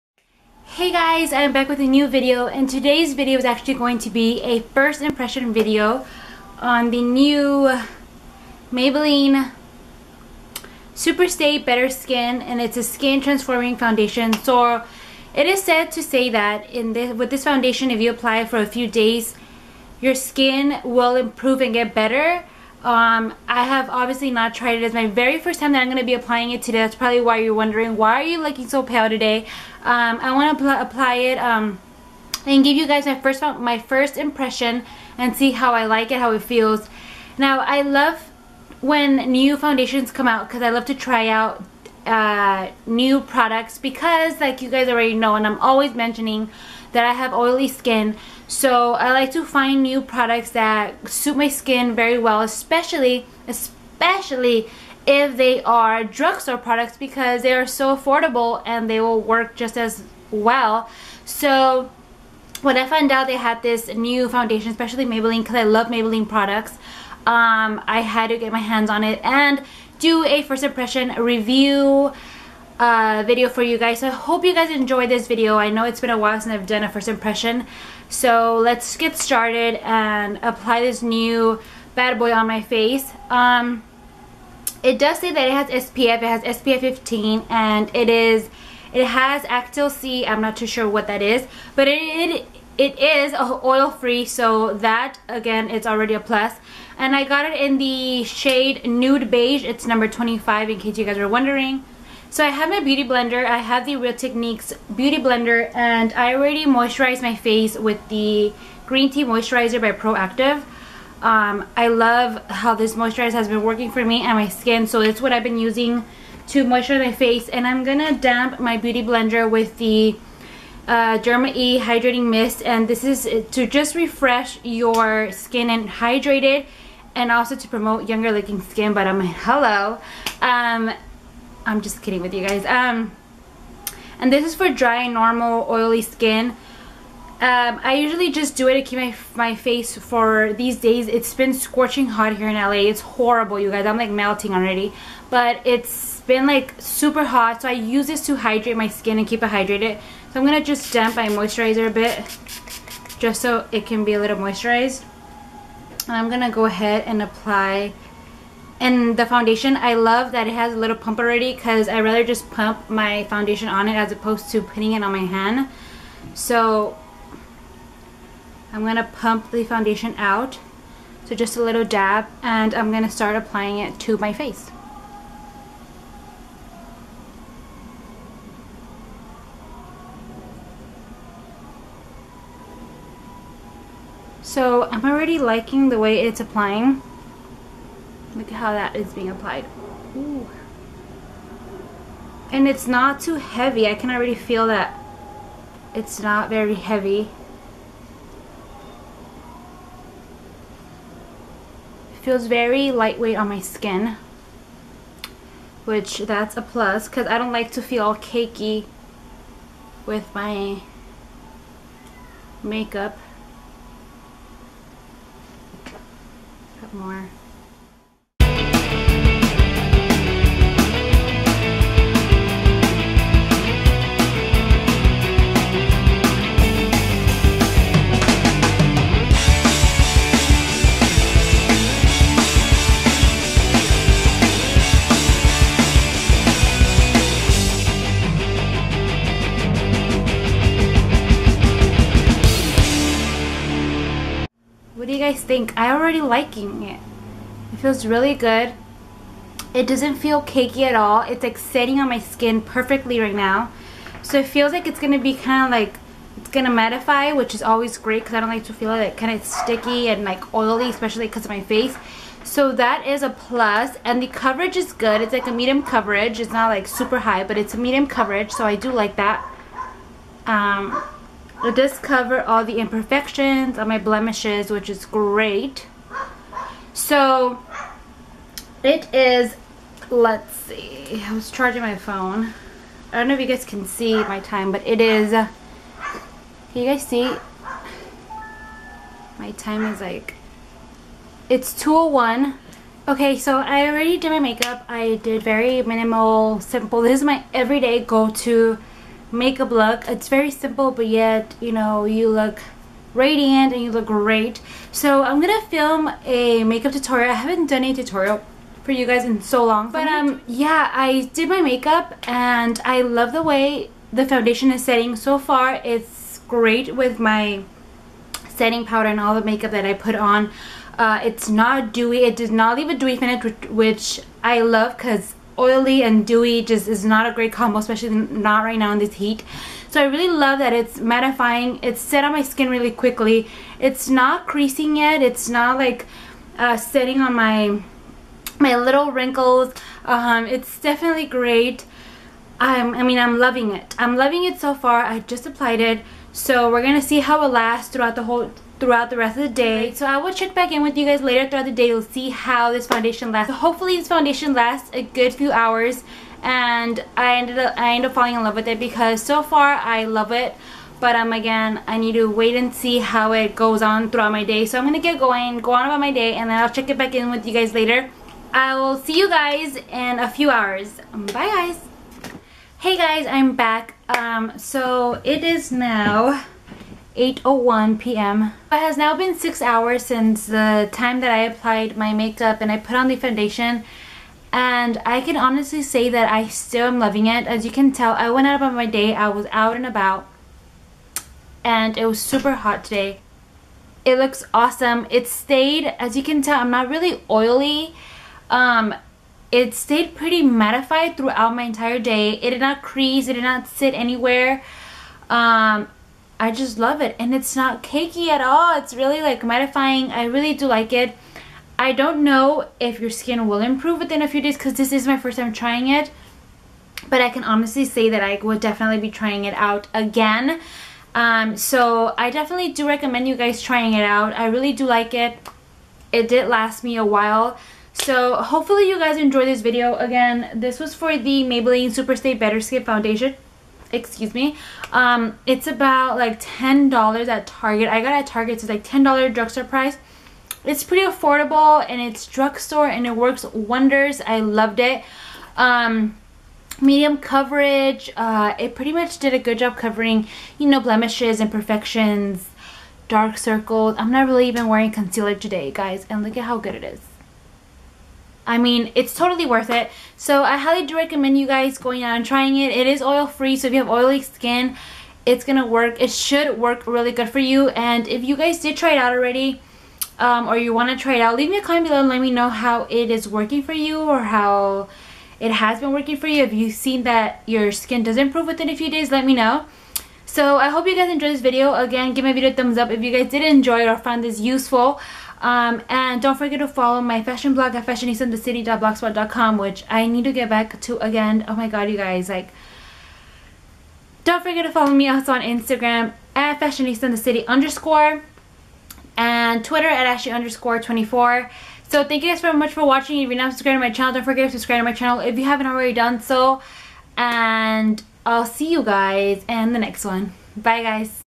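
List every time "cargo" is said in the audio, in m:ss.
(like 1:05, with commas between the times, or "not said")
not said.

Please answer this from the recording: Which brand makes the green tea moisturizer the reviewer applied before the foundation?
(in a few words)
Proactiv.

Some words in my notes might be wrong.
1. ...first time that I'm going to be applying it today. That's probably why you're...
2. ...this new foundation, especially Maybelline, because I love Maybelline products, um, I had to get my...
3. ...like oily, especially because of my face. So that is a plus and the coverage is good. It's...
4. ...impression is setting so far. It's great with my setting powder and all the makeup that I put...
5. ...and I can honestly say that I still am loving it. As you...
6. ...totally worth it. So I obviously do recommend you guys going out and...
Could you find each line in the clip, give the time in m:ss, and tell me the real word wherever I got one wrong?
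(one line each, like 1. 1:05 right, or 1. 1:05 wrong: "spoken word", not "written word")
1. 0:25 right
2. 1:03 right
3. 4:20 right
4. 5:14 wrong: "foundation", not "impression"
5. 6:24 right
6. 7:39 wrong: "highly", not "obviously".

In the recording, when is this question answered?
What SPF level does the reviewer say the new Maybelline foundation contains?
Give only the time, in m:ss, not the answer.
1:26.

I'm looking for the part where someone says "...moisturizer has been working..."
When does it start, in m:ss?
1:52.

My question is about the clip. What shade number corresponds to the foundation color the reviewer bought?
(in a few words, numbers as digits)
25.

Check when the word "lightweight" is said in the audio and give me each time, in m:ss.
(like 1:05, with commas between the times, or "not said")
3:22.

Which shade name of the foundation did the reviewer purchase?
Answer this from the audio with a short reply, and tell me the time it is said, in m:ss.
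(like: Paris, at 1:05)
Nude Beige, at 1:38.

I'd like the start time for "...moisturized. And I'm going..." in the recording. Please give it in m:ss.
2:34.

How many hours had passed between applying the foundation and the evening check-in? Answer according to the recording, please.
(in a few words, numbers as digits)
6 hours.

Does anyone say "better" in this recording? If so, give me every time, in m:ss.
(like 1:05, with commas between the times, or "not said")
0:11, 0:21, 7:12.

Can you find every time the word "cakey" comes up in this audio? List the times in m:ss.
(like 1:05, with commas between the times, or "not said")
3:28, 4:10, 6:47.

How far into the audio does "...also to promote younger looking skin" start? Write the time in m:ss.
2:07.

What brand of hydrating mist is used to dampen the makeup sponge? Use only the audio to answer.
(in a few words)
Derma E.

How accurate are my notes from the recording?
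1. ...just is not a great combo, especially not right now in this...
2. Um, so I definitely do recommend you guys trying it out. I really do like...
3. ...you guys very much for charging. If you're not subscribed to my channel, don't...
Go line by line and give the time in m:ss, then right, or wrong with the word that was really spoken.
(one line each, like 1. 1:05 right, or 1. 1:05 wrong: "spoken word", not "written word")
1. 5:26 right
2. 7:01 right
3. 8:22 wrong: "watching", not "charging".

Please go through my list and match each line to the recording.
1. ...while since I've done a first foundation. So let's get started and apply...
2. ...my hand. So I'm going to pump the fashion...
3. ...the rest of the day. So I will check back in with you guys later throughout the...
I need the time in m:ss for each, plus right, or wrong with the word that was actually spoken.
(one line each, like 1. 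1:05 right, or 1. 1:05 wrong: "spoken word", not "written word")
1. 1:16 wrong: "impression", not "foundation"
2. 2:45 wrong: "foundation", not "fashion"
3. 5:49 right.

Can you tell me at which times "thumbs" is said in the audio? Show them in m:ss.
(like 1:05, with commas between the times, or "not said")
8:02.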